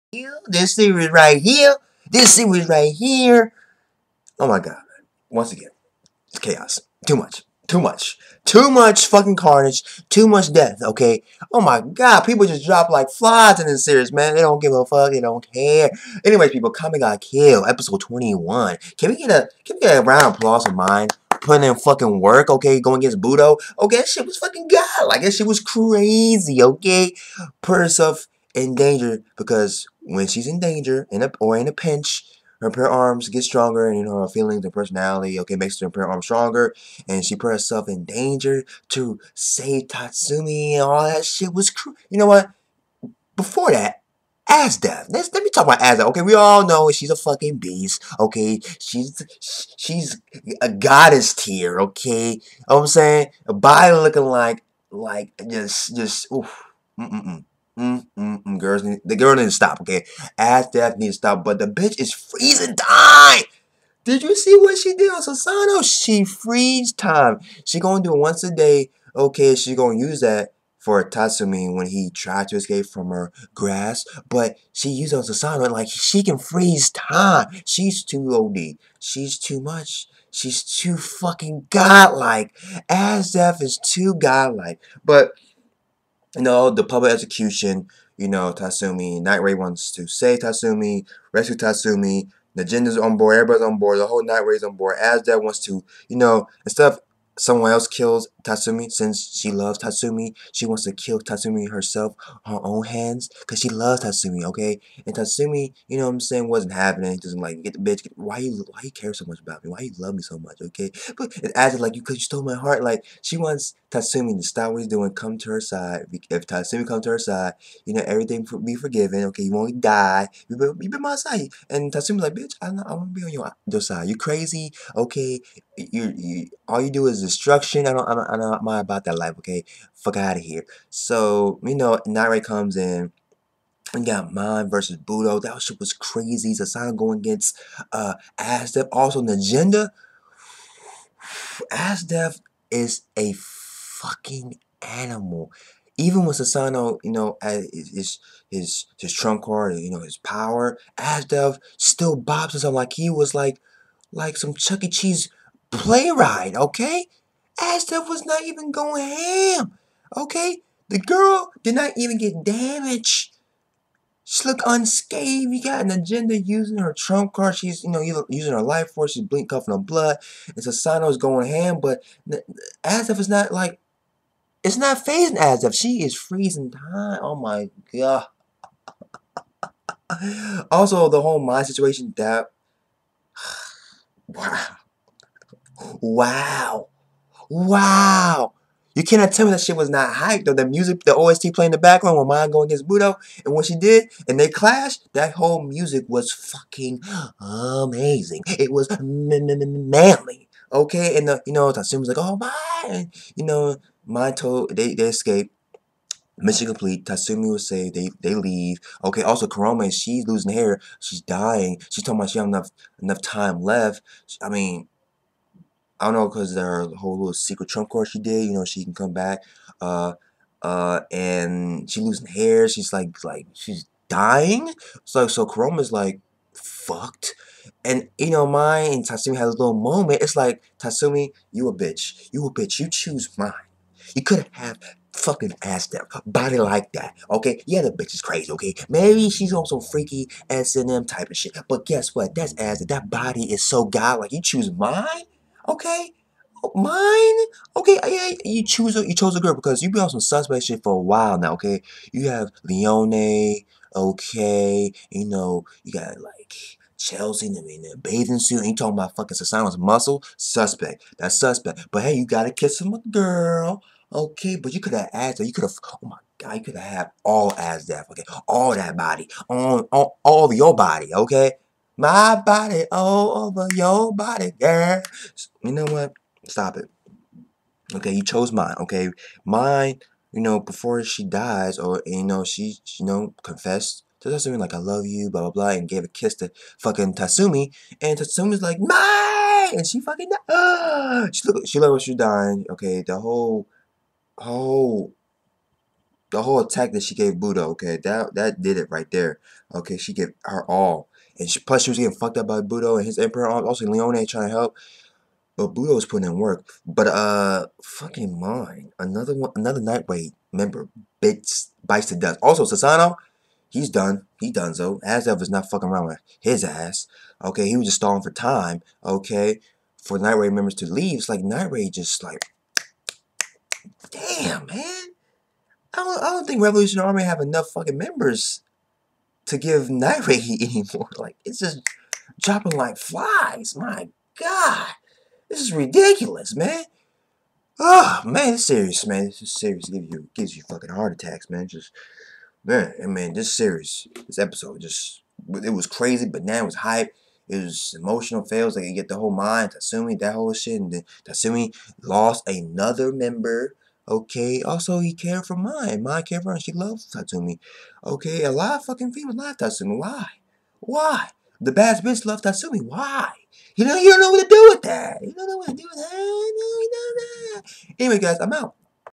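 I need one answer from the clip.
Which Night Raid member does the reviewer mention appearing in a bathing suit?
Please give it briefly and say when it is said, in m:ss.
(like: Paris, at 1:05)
Chelsea, at 4:16.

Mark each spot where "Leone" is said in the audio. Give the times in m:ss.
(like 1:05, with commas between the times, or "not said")
4:12, 5:03.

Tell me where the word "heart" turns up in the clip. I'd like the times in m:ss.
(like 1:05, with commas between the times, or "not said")
1:52, 5:40.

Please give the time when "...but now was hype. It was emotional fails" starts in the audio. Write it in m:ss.
5:46.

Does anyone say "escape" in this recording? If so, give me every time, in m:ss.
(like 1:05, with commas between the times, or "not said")
1:12, 3:25.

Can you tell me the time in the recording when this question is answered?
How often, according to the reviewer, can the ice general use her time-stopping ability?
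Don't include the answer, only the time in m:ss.
1:08.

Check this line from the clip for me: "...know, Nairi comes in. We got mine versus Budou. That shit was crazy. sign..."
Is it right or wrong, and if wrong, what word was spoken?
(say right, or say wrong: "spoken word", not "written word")
right.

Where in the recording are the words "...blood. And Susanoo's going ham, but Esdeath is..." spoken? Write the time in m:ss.
2:49.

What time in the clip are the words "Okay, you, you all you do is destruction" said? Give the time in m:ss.
2:04.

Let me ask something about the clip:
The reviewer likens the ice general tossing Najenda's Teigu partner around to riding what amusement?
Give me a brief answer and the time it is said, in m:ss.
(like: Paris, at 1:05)
Chuck E. Cheese ride, at 2:34.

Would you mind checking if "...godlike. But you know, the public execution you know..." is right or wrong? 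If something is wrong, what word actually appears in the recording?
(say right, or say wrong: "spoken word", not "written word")
right.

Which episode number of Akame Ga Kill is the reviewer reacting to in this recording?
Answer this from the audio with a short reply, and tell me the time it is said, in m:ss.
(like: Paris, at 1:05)
21, at 0:17.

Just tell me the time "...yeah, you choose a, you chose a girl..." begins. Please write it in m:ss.
4:08.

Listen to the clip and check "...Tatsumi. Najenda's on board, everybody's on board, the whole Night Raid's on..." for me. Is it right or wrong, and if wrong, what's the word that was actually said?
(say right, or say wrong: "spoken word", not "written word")
right.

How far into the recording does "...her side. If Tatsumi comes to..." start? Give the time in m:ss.
1:55.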